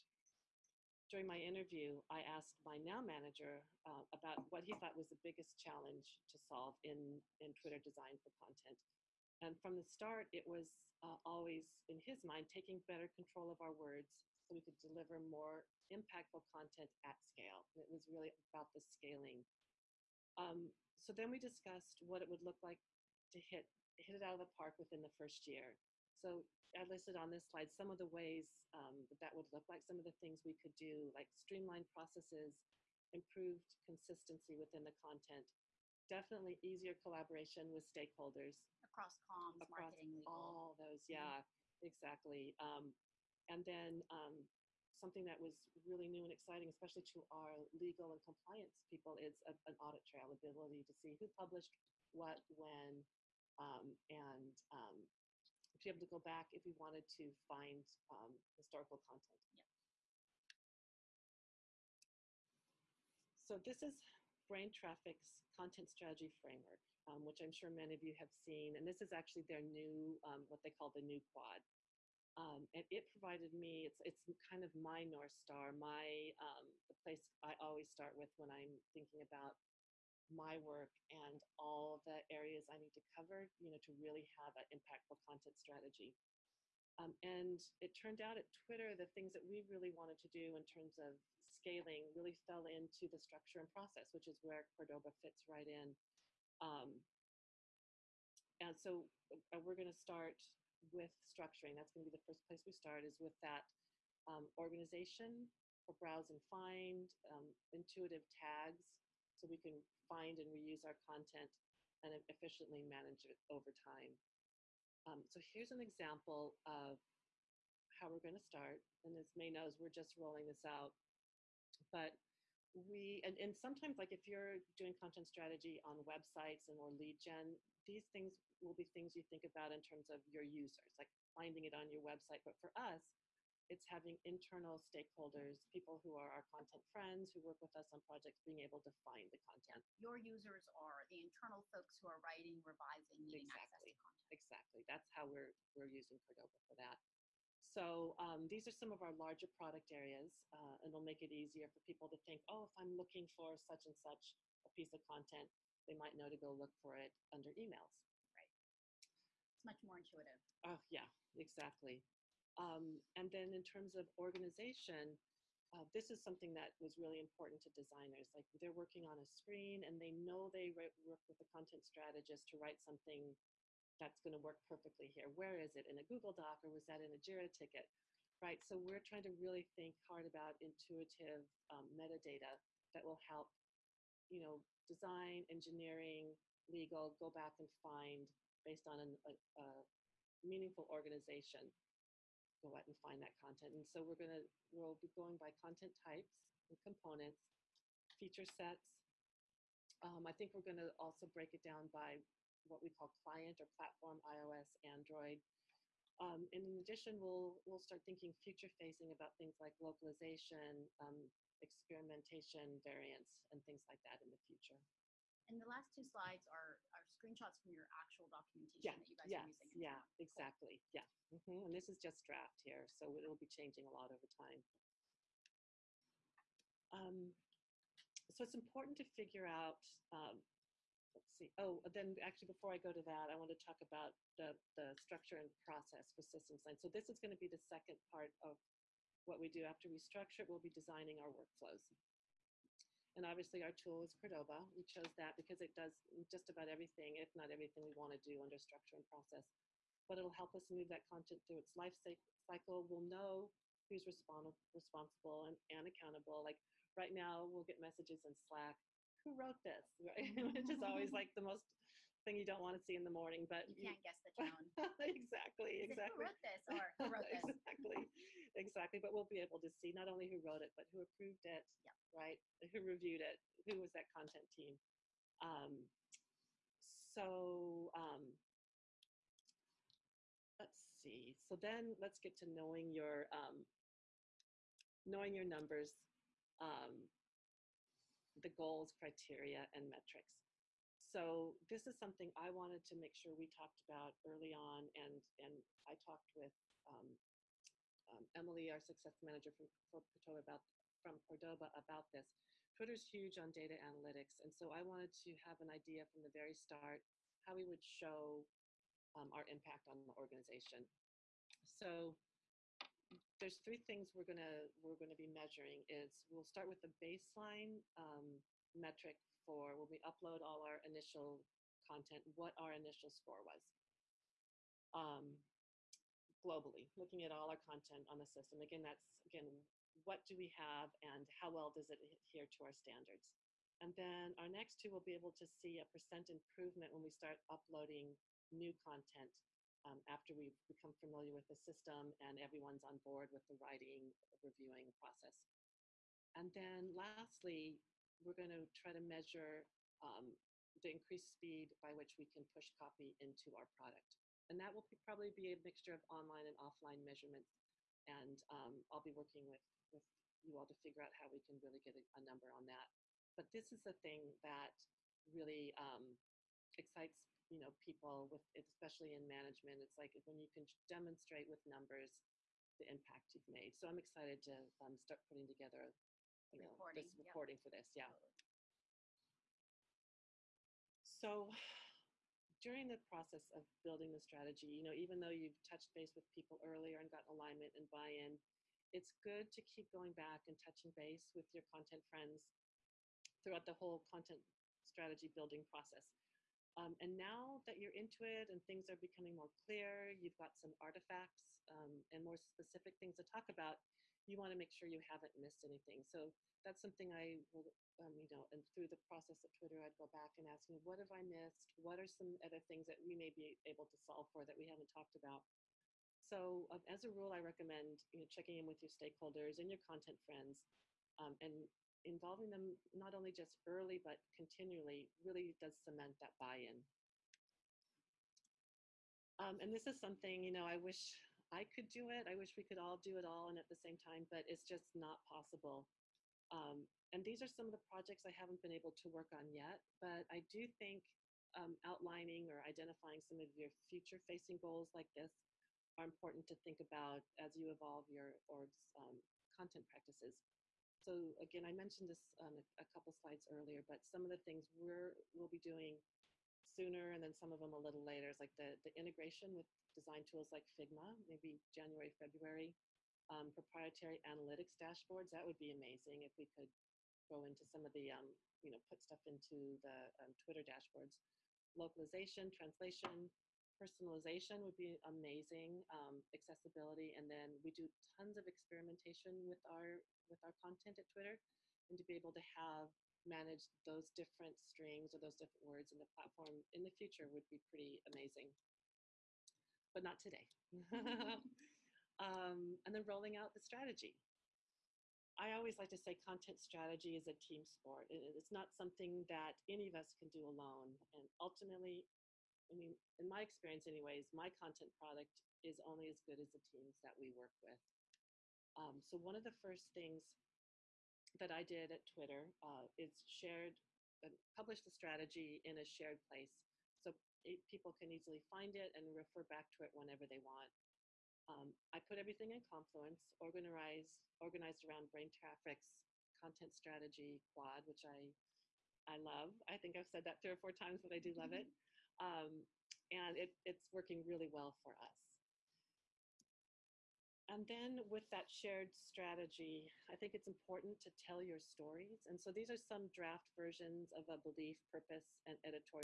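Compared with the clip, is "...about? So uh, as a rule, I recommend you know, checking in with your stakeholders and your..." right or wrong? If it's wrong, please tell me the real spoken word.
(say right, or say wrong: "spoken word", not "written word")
right.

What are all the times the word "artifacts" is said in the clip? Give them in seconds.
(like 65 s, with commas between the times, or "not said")
400 s.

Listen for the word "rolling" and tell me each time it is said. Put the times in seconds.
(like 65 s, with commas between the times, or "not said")
120 s, 493 s.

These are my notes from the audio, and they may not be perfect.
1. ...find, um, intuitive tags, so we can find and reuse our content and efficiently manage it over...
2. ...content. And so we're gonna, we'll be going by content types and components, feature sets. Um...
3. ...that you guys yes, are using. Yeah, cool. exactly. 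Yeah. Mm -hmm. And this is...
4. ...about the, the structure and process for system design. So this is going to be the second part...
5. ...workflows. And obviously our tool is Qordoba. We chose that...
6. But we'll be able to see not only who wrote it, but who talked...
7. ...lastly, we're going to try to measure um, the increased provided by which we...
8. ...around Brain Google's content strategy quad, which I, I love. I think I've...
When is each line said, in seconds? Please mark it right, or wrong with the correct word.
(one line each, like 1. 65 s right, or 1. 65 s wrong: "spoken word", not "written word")
1. 106 s right
2. 193 s right
3. 218 s right
4. 233 s right
5. 241 s right
6. 268 s wrong: "approved", not "talked"
7. 346 s wrong: "speed", not "provided"
8. 524 s wrong: "Traffic", not "Google".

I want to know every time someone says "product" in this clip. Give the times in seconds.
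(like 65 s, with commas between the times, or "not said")
149 s, 353 s, 504 s.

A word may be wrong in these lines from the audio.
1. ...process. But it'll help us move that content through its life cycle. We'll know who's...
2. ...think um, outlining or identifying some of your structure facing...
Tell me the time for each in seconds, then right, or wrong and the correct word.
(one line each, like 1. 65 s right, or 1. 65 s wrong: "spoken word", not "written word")
1. 249 s right
2. 440 s wrong: "future", not "structure".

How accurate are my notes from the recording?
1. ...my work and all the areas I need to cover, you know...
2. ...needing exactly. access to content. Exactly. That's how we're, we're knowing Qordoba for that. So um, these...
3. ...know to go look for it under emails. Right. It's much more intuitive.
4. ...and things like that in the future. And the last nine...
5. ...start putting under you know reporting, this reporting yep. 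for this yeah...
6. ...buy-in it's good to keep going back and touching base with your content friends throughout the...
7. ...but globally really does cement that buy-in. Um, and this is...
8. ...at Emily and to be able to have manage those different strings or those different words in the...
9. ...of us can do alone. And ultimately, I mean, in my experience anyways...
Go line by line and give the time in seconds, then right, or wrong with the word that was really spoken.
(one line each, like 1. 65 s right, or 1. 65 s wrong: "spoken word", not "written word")
1. 80 s right
2. 143 s wrong: "using", not "knowing"
3. 156 s right
4. 213 s wrong: "two", not "nine"
5. 374 s wrong: "together", not "under"
6. 387 s right
7. 423 s wrong: "continually", not "globally"
8. 480 s wrong: "Twitter", not "Emily"
9. 499 s right.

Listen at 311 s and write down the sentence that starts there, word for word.
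So there's three things we're gonna we're gonna be measuring.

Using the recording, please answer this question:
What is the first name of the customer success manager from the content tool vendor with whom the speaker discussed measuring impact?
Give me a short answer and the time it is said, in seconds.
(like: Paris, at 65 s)
Emily, at 298 s.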